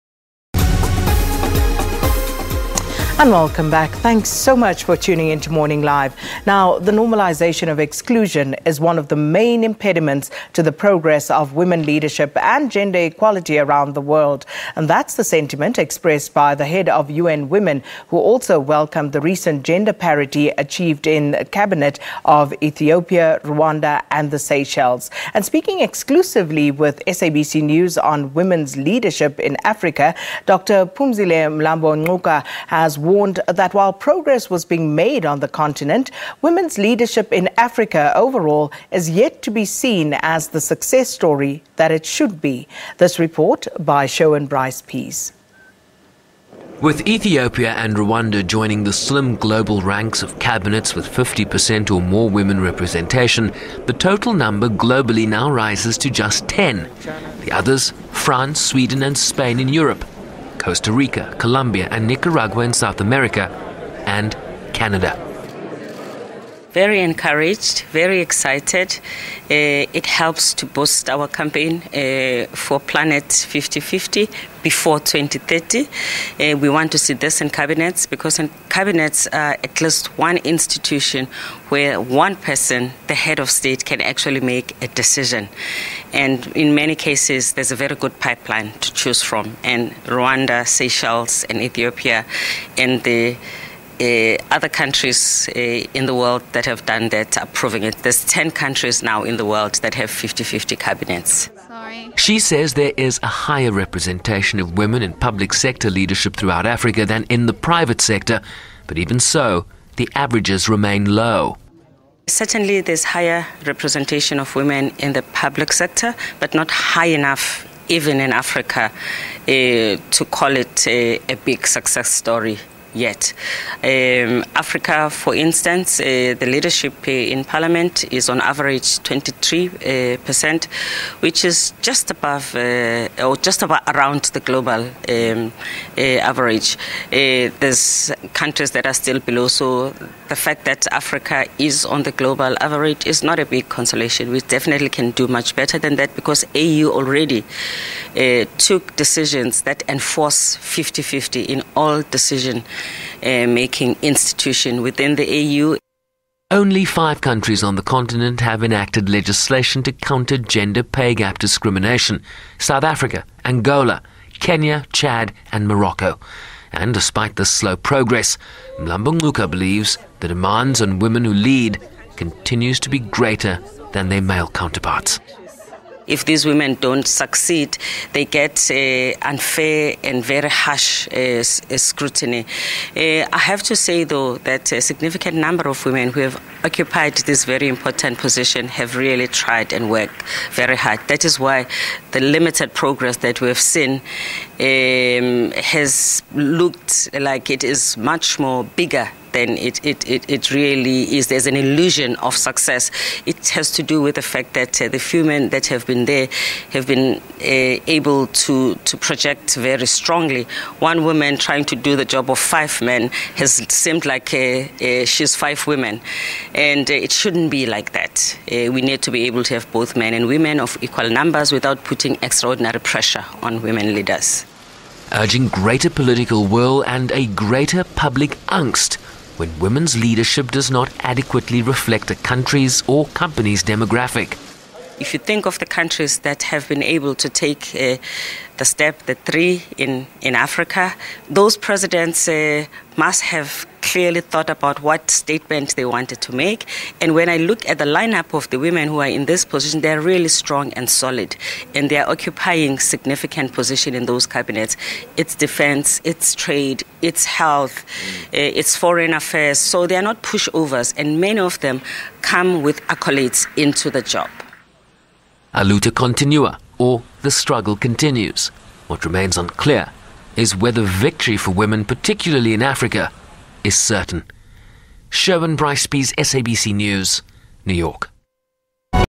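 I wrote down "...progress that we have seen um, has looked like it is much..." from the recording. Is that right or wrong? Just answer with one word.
right.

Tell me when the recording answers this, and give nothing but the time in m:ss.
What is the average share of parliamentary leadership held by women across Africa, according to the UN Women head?
2:09.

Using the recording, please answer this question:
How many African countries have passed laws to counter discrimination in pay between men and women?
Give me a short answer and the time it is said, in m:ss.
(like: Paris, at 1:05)
5, at 2:36.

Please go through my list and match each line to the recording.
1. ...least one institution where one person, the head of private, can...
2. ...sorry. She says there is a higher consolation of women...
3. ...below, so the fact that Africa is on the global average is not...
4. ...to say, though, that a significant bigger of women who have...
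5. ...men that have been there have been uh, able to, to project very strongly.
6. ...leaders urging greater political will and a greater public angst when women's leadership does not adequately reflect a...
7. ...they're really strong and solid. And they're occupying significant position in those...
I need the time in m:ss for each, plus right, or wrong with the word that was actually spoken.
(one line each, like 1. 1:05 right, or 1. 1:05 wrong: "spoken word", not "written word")
1. 1:19 wrong: "state", not "private"
2. 1:41 wrong: "representation", not "consolation"
3. 2:19 right
4. 3:03 wrong: "number", not "bigger"
5. 3:25 right
6. 3:43 right
7. 4:09 right.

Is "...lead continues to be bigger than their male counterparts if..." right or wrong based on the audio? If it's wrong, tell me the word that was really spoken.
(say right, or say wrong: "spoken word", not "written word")
wrong: "greater", not "bigger".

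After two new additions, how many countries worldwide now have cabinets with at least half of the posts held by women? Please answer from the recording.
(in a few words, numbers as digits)
10.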